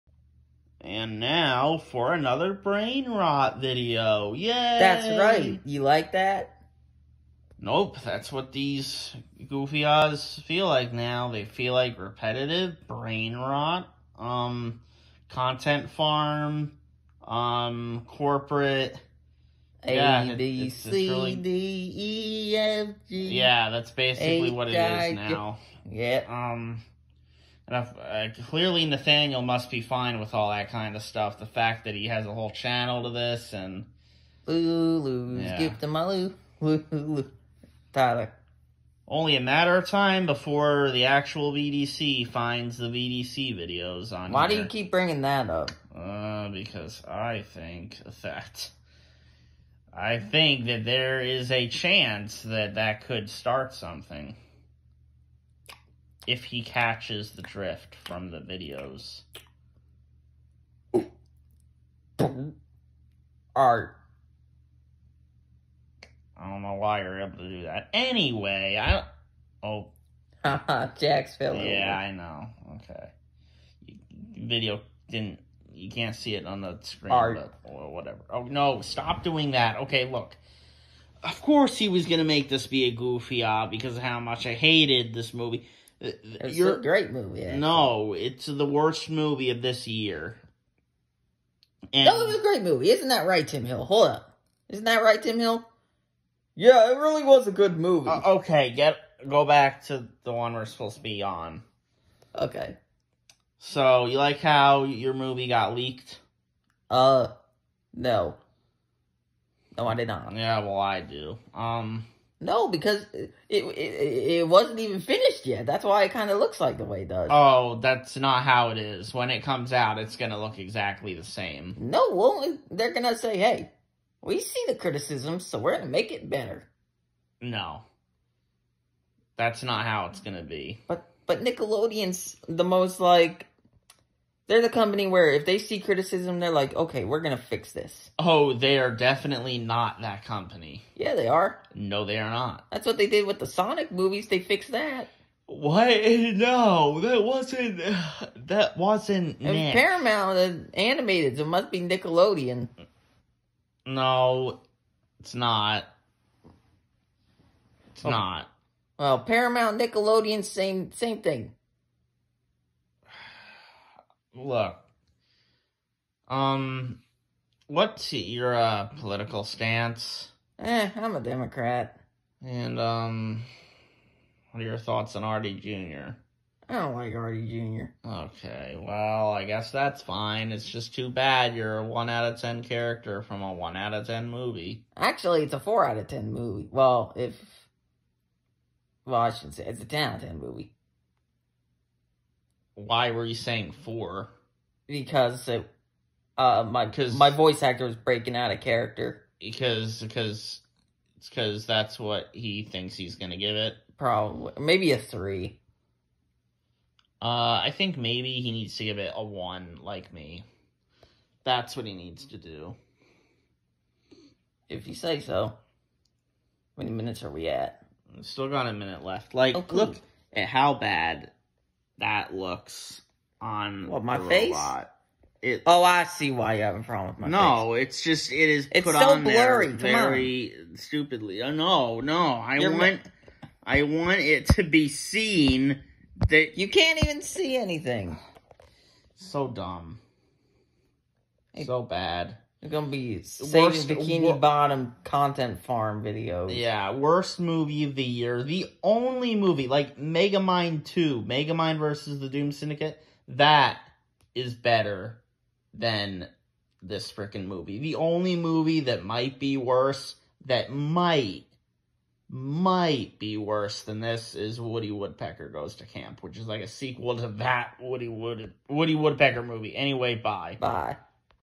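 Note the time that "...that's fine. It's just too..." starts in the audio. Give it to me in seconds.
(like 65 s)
179 s.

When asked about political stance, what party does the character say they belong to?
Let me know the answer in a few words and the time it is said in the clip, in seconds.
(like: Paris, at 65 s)
Democrat, at 171 s.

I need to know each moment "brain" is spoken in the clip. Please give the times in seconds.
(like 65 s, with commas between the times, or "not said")
2 s, 12 s.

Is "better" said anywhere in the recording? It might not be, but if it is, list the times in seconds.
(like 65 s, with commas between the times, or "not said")
126 s, 254 s.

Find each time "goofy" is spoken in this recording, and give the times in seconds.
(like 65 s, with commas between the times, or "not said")
9 s, 82 s.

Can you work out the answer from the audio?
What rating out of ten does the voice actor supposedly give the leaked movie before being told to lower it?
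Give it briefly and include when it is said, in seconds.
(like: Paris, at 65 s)
4, at 185 s.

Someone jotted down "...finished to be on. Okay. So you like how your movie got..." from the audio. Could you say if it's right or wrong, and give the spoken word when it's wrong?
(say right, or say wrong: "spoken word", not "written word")
wrong: "supposed", not "finished".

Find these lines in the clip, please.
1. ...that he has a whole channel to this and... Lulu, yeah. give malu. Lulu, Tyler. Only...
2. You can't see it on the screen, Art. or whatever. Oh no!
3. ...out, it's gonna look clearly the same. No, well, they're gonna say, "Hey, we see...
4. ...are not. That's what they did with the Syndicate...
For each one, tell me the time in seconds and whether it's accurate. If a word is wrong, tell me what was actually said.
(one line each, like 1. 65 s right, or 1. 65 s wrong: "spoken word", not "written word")
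1. 31 s right
2. 75 s right
3. 119 s wrong: "exactly", not "clearly"
4. 142 s wrong: "Sonic", not "Syndicate".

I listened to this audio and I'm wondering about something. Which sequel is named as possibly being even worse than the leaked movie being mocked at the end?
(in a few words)
Woody Woodpecker Goes to Camp.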